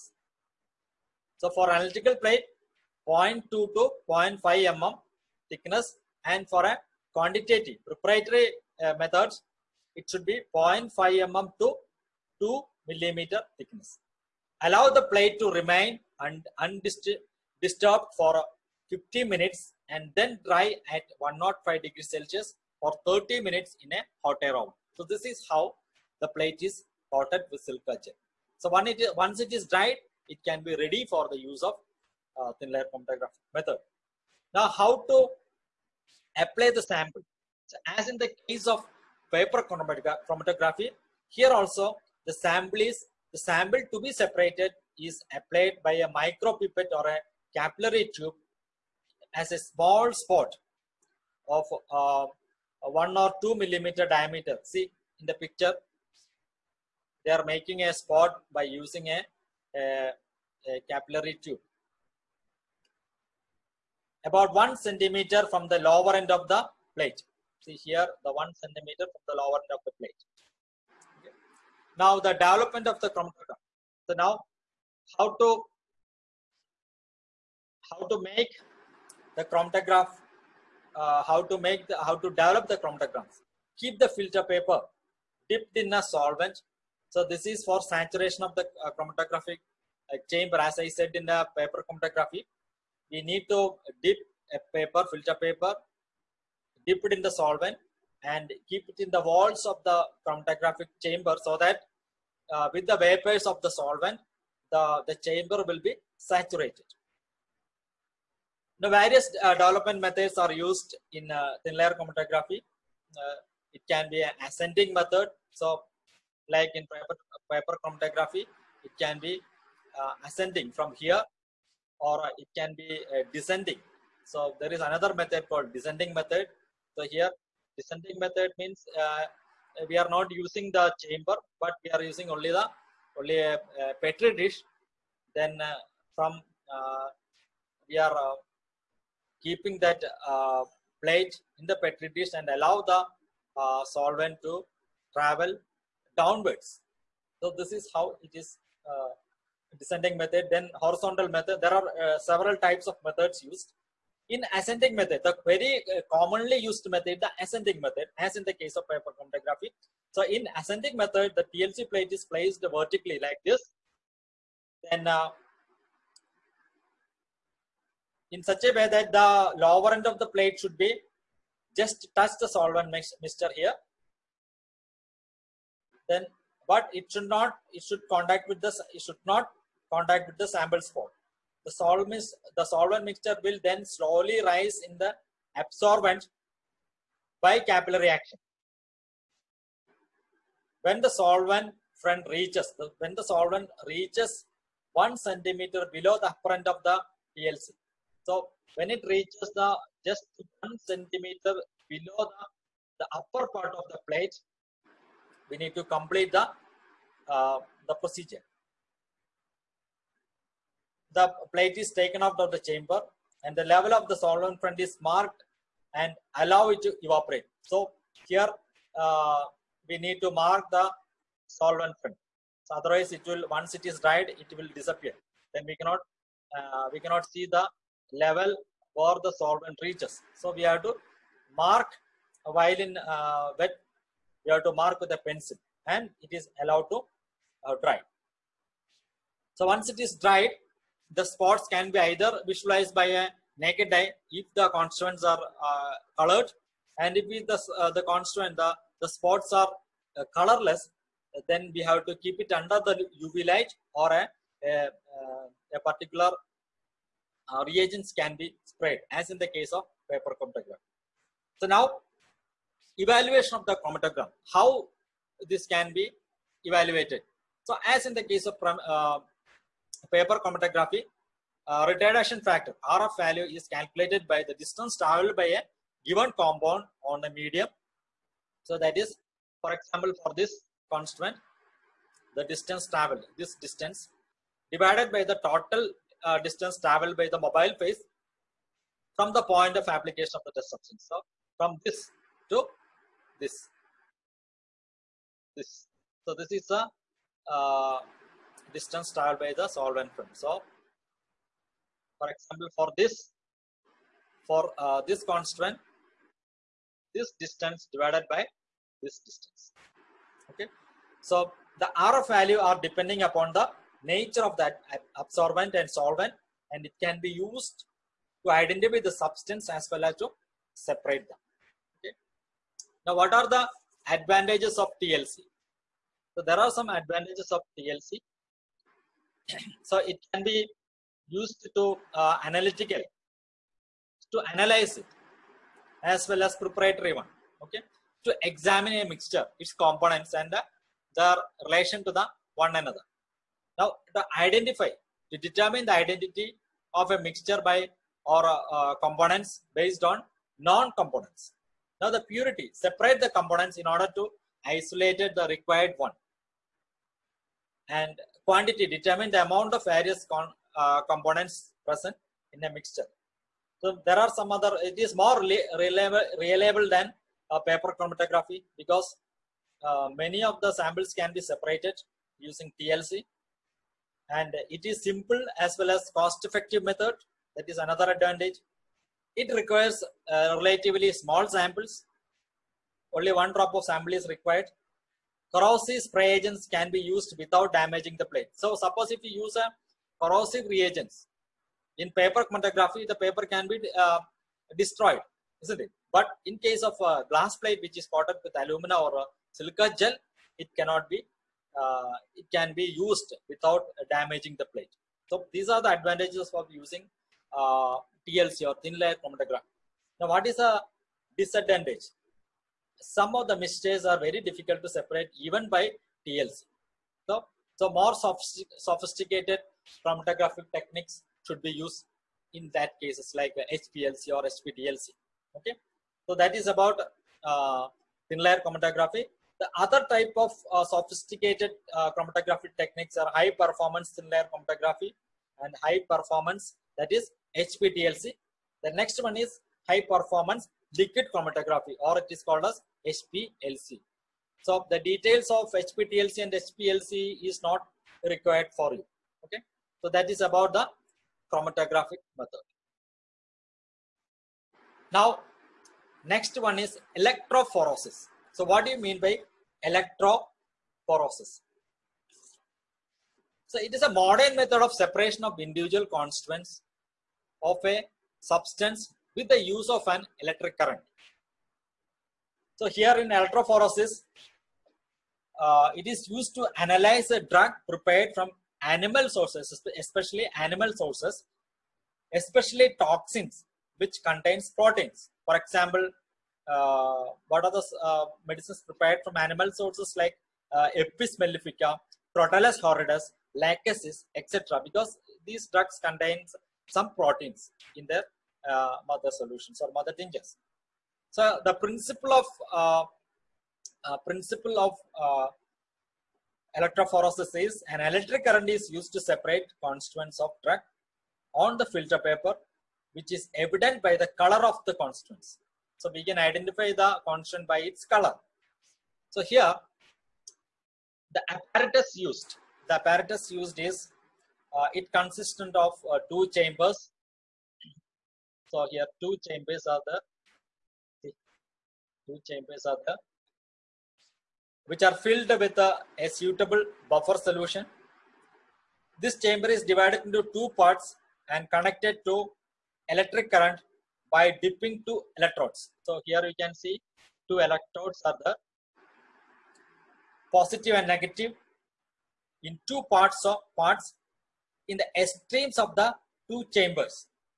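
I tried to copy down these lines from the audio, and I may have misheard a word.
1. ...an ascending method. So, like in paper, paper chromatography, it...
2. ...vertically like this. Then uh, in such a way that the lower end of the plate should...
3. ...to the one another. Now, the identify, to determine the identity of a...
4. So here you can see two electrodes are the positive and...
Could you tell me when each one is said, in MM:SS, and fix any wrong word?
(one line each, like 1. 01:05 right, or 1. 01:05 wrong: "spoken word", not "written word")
1. 01:54 right
2. 02:42 right
3. 05:42 right
4. 09:06 right.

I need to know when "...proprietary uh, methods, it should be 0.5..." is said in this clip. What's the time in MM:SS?
00:07.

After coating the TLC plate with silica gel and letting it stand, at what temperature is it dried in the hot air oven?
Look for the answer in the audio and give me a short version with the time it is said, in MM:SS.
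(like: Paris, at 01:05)
105 degrees Celsius, at 00:21.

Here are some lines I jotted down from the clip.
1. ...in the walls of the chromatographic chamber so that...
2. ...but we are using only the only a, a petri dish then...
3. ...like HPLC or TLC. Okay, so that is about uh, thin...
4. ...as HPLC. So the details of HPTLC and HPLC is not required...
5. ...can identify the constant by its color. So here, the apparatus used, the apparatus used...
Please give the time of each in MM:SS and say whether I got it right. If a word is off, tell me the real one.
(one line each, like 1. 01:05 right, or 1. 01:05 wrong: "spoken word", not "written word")
1. 01:39 right
2. 02:11 right
3. 07:03 wrong: "HPTLC", not "TLC"
4. 07:22 right
5. 08:36 right.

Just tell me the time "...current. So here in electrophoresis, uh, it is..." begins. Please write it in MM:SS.
07:50.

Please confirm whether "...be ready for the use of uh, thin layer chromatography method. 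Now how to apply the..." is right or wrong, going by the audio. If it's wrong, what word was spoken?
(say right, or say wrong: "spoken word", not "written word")
right.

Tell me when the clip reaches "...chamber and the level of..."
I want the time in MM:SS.
03:32.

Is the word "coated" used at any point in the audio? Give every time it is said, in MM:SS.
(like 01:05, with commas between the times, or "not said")
00:27, 06:38.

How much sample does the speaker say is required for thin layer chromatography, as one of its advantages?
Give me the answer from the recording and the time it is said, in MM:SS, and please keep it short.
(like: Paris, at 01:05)
one drop, at 06:23.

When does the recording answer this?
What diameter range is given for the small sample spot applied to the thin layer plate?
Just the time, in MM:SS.
00:52.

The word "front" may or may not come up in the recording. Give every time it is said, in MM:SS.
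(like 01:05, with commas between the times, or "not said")
03:11, 03:34, 03:41.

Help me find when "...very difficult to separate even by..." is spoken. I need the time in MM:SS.
06:54.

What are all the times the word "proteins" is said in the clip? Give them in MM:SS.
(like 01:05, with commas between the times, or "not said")
08:04, 08:17.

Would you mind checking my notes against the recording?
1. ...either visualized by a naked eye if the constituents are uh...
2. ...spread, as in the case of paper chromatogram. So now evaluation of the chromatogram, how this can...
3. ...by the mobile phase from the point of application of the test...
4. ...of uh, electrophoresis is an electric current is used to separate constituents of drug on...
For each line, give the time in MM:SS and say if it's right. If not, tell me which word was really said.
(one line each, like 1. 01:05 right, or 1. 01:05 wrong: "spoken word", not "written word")
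1. 04:01 right
2. 04:18 right
3. 04:47 right
4. 08:24 right.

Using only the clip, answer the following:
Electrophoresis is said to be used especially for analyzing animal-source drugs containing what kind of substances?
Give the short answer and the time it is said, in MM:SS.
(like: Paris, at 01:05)
toxins, at 08:02.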